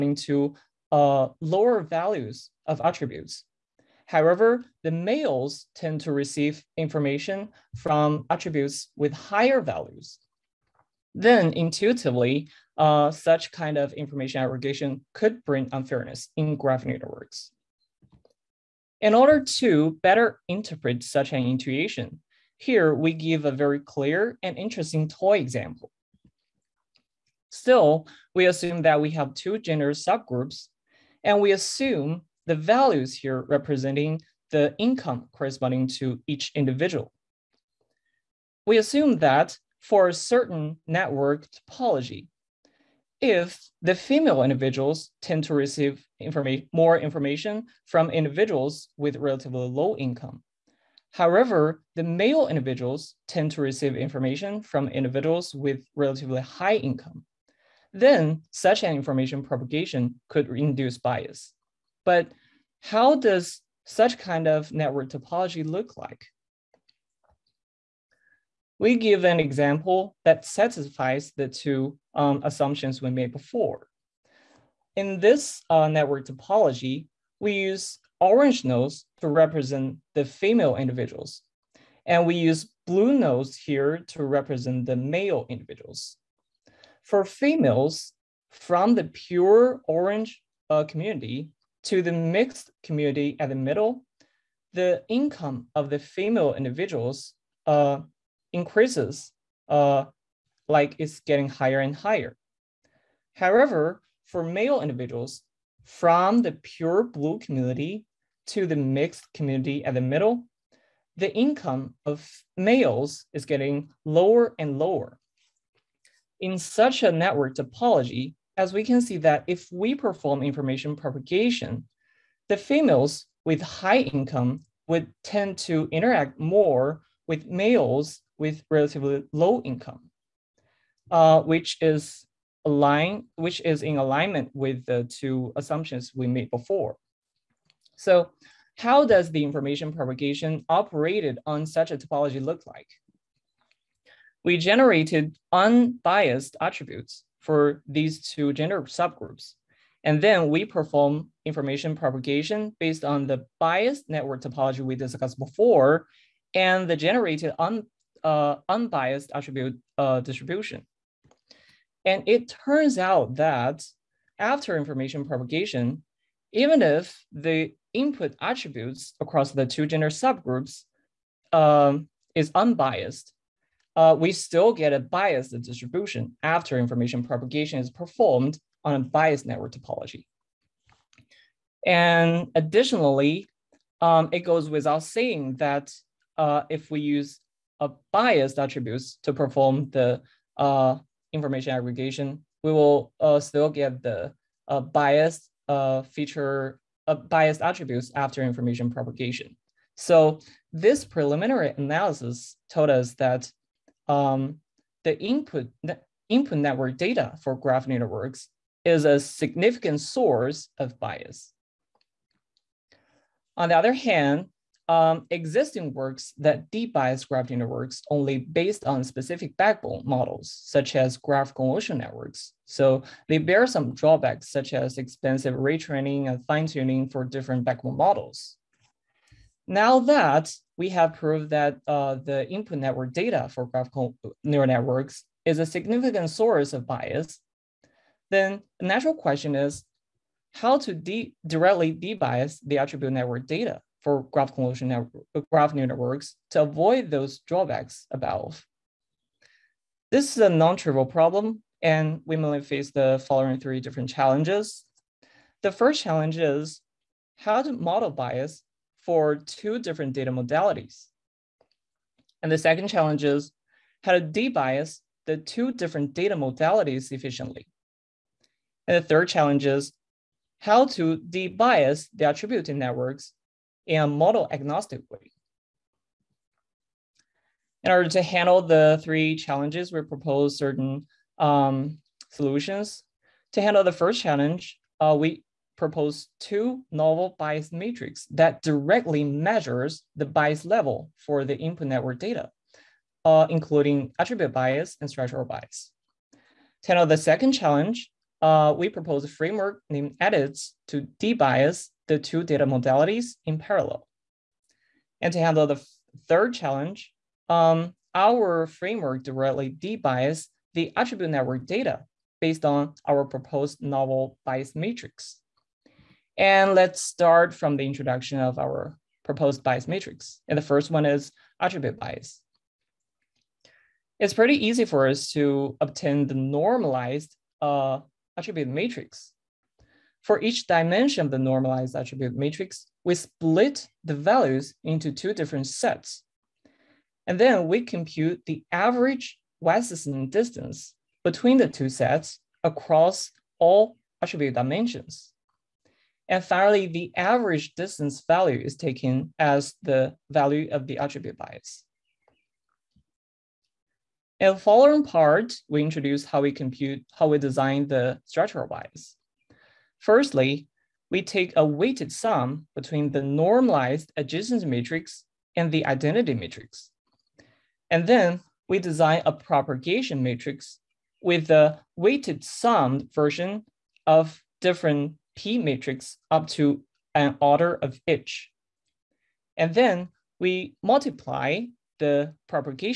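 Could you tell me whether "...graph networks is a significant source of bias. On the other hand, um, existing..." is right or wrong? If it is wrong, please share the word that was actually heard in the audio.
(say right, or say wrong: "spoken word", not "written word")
right.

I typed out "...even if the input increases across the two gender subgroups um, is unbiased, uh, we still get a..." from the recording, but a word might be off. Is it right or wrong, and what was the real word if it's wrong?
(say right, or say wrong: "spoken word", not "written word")
wrong: "attributes", not "increases".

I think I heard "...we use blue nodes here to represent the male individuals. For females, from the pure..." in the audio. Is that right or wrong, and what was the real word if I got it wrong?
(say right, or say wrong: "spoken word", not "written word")
right.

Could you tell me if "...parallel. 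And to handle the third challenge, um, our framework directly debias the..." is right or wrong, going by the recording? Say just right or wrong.
right.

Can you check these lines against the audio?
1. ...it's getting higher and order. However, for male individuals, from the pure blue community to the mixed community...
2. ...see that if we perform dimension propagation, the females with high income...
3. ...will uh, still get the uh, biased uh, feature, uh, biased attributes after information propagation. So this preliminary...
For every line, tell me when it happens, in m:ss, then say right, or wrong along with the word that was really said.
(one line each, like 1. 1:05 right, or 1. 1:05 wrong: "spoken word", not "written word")
1. 1:40 wrong: "higher", not "order"
2. 1:59 wrong: "information", not "dimension"
3. 3:12 right.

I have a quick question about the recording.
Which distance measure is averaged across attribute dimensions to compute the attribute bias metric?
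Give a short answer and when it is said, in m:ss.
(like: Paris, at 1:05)
Wasserstein distance, at 5:39.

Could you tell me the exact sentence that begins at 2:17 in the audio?
So how does the information propagation operated on such a topology look like?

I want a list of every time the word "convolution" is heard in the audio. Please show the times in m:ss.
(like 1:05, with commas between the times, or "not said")
3:41, 4:04.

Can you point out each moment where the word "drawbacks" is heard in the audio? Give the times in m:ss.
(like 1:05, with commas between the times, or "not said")
3:43, 4:07.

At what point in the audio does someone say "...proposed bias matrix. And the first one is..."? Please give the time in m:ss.
5:19.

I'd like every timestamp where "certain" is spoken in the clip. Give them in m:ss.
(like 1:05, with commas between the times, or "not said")
0:40, 4:40.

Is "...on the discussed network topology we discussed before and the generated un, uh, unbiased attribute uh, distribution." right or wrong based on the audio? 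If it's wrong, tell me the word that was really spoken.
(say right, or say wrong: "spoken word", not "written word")
wrong: "biased", not "discussed".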